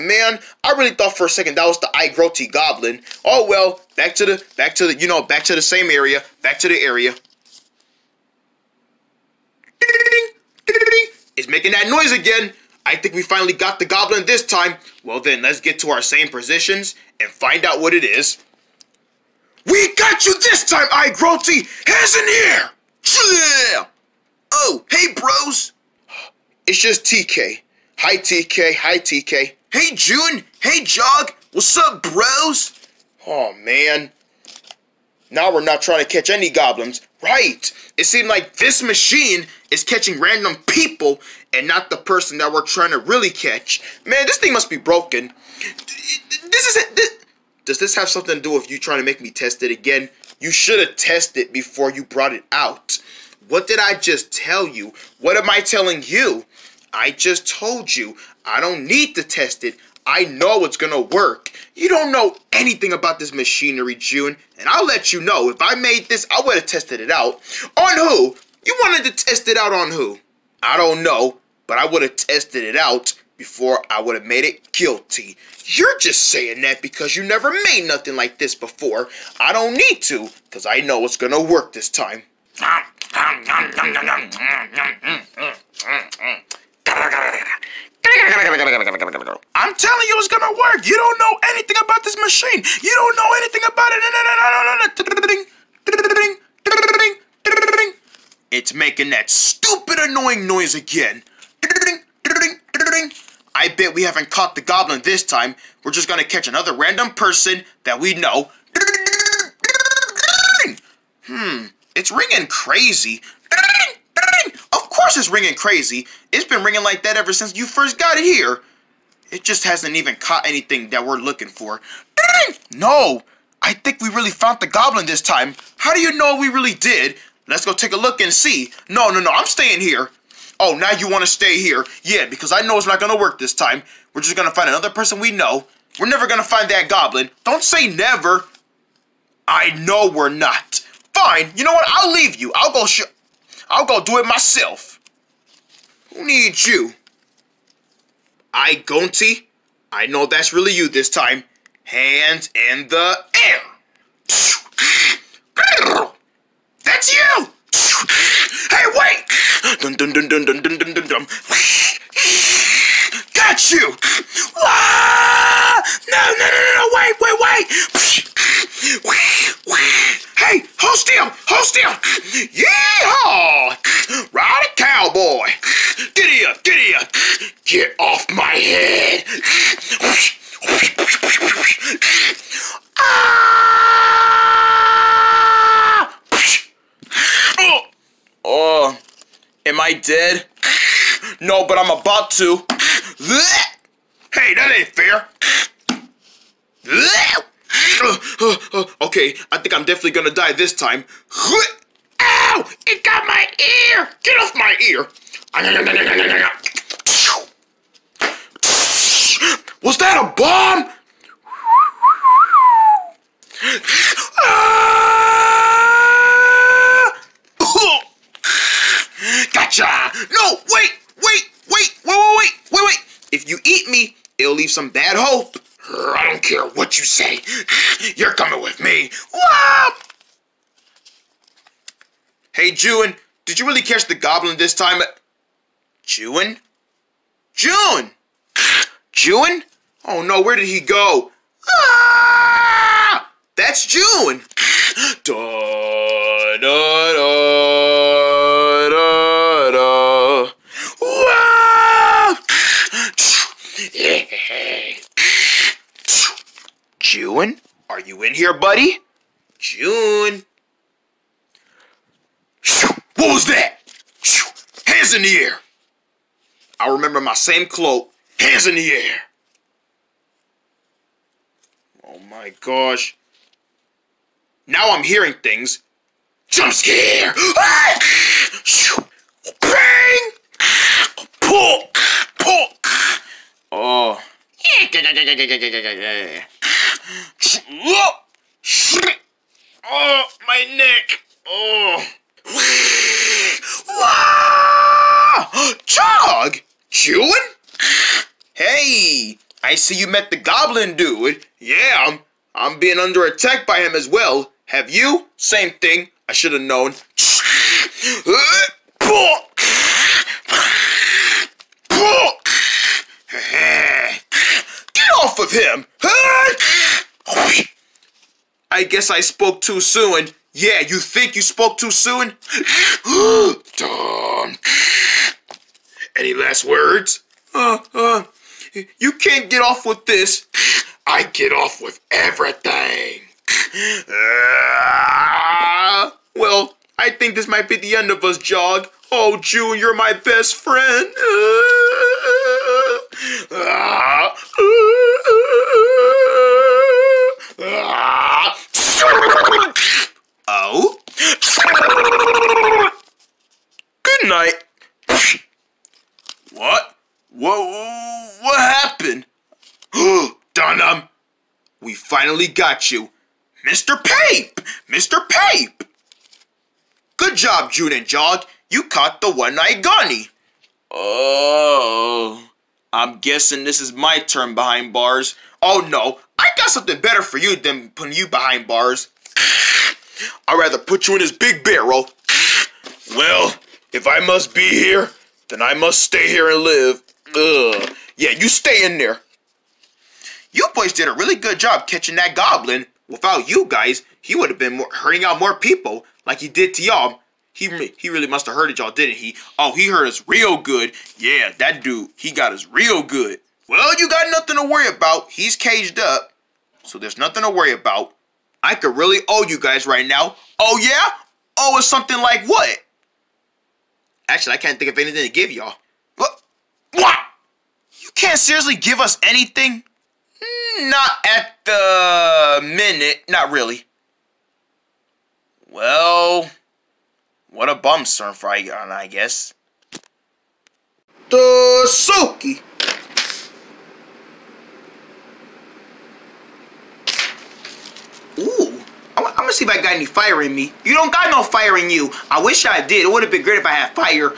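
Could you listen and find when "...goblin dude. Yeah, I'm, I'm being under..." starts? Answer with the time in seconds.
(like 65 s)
300 s.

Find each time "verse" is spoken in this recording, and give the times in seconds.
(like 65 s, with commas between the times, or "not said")
not said.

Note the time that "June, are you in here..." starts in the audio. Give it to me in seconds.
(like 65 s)
257 s.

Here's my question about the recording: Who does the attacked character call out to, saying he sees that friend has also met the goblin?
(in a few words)
Chog.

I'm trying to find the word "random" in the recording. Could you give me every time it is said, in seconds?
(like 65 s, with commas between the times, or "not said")
40 s, 106 s.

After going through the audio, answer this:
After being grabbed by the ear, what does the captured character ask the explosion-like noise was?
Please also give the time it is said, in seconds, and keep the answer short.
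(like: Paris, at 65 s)
A bomb, at 210 s.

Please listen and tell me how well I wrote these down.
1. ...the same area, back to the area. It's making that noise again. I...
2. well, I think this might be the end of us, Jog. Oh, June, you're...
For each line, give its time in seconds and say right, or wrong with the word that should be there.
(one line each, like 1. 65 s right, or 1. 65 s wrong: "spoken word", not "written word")
1. 5 s right
2. 336 s right.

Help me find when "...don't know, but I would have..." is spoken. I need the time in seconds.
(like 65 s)
70 s.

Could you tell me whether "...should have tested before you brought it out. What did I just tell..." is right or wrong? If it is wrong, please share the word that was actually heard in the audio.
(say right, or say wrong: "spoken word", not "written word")
right.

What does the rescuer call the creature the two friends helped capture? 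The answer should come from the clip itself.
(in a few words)
The one-eyed gani.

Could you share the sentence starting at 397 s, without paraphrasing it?
He he really must have heard it, y'all, didn't he?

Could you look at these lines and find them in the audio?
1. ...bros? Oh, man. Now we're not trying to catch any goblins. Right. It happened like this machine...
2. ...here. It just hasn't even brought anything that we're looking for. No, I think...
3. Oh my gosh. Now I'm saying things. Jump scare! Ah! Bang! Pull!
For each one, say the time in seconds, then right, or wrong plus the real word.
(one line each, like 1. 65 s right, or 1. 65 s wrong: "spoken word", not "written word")
1. 32 s wrong: "seemed", not "happened"
2. 118 s wrong: "caught", not "brought"
3. 272 s wrong: "hearing", not "saying".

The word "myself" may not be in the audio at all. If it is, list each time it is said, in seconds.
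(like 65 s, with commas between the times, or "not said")
144 s.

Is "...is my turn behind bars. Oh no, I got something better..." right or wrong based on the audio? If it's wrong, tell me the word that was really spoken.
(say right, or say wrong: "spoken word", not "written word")
right.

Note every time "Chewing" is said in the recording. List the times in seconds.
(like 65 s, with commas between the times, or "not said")
296 s.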